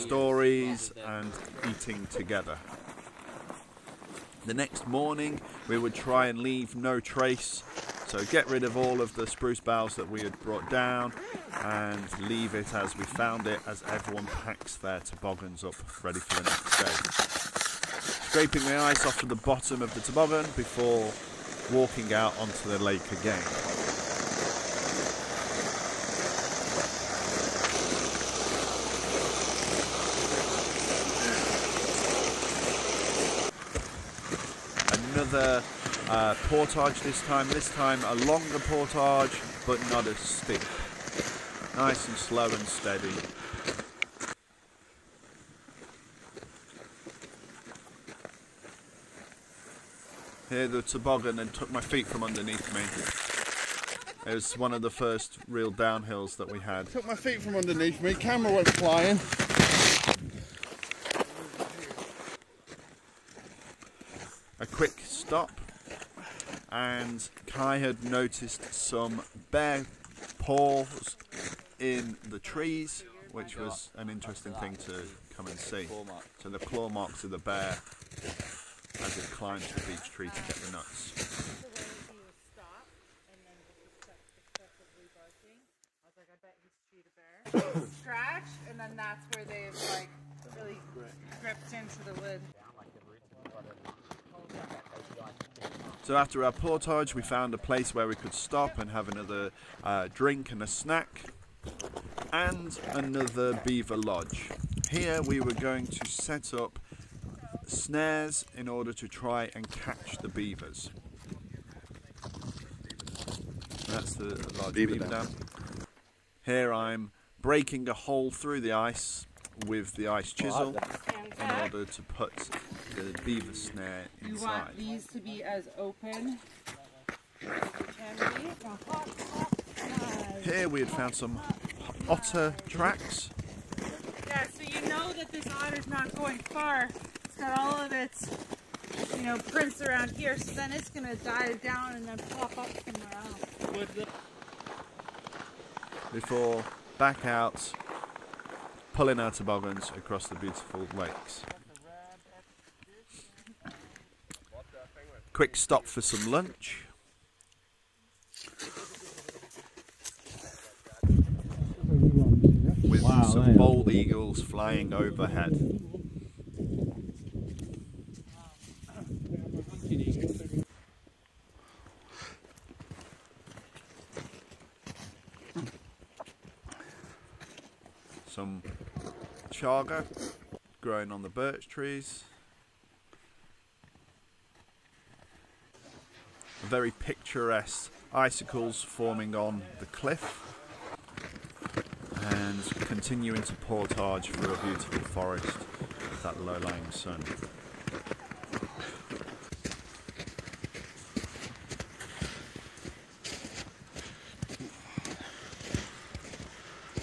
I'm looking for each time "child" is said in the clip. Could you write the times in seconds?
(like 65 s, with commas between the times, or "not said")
not said.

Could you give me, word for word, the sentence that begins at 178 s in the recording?
Some chaga growing on the birch trees.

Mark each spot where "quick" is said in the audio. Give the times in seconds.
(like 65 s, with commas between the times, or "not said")
64 s, 155 s.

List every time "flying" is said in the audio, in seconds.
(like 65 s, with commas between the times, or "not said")
58 s, 164 s.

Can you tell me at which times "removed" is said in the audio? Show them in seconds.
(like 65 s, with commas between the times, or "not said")
not said.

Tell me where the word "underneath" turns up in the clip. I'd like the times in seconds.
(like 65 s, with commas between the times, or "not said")
52 s, 57 s.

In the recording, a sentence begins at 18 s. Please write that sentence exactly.
Scraping the ice off to the bottom of the toboggan before walking out onto the lake again.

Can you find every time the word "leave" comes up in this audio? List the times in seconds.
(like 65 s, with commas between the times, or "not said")
6 s, 12 s.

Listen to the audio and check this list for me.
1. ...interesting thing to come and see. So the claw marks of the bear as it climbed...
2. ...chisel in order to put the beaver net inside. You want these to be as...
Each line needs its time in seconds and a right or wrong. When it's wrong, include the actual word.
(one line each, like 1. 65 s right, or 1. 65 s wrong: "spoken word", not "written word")
1. 74 s right
2. 120 s right.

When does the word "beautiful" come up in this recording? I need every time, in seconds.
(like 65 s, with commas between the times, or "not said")
150 s, 194 s.